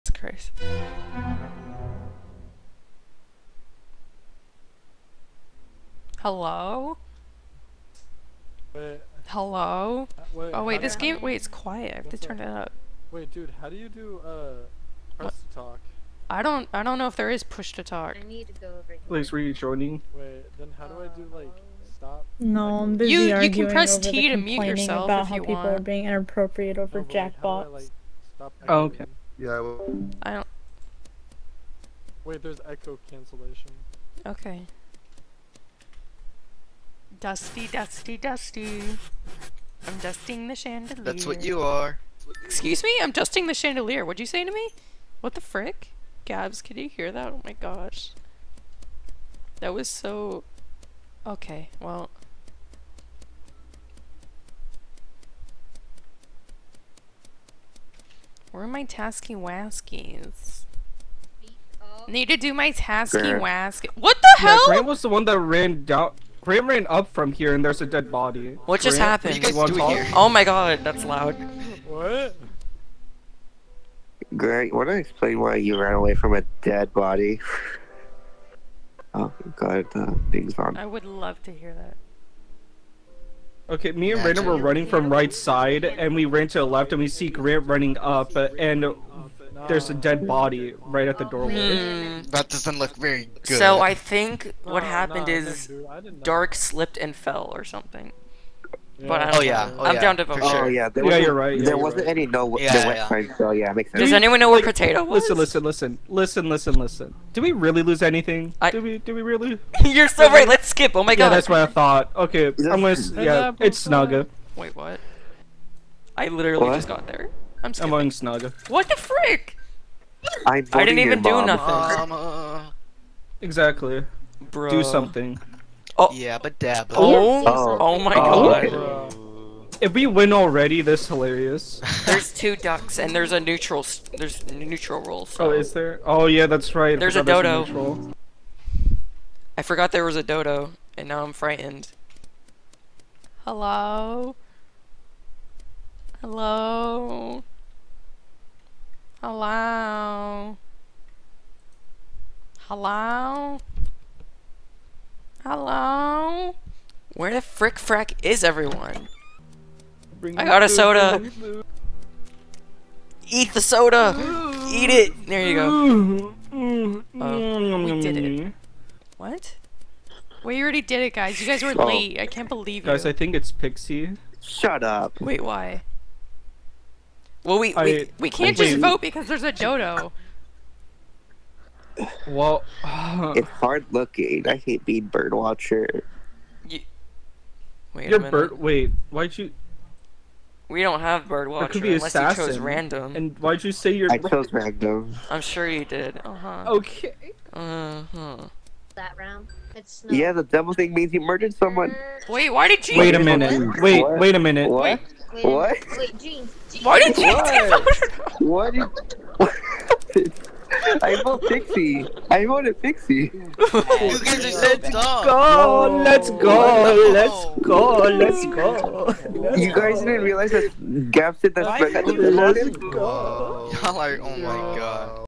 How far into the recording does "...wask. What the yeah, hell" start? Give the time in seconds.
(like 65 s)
63 s.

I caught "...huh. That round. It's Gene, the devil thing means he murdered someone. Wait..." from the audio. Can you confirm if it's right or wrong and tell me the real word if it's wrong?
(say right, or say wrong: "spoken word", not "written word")
wrong: "Yeah", not "Gene".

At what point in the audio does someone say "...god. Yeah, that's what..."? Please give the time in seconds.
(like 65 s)
111 s.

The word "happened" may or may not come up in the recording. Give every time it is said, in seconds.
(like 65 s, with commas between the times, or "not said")
68 s, 94 s.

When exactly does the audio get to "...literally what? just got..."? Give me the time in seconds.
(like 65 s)
116 s.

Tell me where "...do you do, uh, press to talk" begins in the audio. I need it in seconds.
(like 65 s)
13 s.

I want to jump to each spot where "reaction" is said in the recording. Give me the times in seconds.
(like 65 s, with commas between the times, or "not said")
not said.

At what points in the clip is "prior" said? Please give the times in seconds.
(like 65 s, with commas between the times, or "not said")
not said.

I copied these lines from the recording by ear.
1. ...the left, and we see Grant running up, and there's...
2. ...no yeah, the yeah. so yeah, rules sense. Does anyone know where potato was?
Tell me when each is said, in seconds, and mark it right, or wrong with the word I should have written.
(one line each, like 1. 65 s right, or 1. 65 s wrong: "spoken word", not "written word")
1. 86 s right
2. 102 s wrong: "makes", not "rules".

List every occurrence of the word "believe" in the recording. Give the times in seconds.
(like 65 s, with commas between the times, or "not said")
172 s.